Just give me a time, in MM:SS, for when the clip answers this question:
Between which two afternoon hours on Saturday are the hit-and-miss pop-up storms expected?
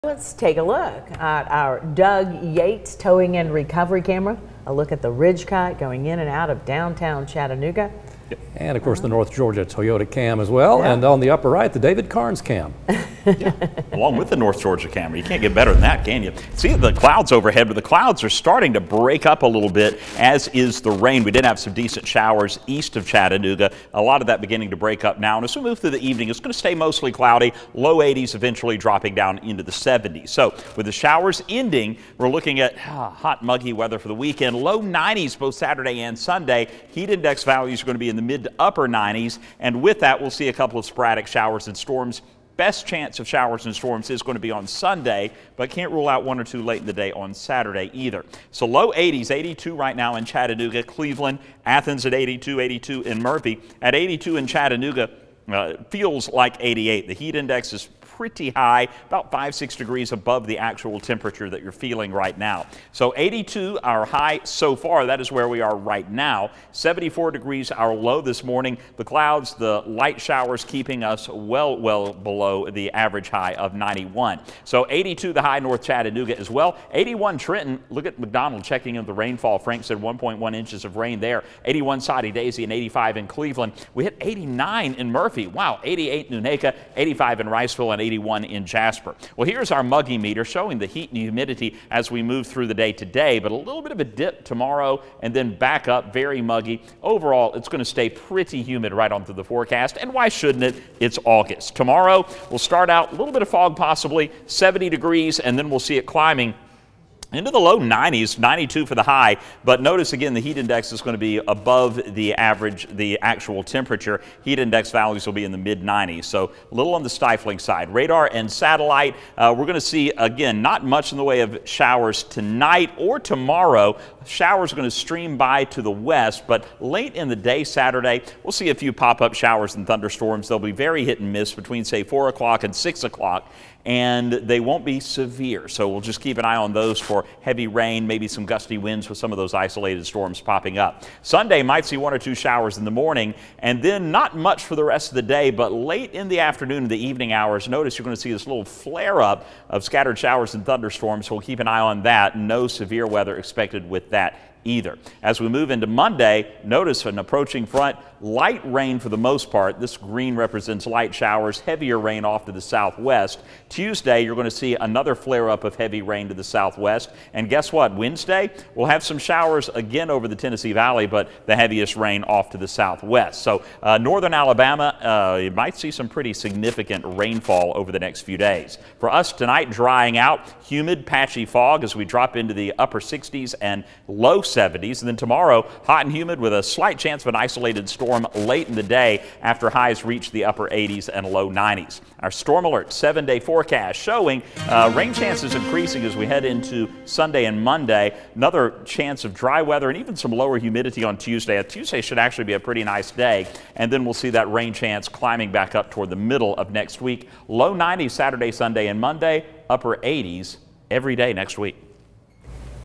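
02:12.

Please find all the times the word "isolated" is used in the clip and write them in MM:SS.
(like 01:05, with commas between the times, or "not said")
02:19, 03:07.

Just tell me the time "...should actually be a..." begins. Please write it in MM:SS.
03:21.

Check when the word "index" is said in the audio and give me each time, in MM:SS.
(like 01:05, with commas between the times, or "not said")
00:37, 00:57, 01:50, 01:54.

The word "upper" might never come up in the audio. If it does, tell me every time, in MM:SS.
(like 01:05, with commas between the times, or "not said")
00:11, 00:38, 03:02, 03:10, 03:29.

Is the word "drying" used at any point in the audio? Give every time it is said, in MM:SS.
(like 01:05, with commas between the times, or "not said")
02:59.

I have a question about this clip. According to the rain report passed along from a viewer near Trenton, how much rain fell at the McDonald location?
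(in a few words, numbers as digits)
1.1 inches.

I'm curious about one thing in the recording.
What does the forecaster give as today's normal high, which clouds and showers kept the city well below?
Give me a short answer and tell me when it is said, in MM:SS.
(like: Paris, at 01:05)
91, at 01:13.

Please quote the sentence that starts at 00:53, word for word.
At 82 in Chattanooga, uh, feels like 88.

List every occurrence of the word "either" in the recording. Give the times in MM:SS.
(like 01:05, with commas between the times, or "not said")
00:47, 02:34.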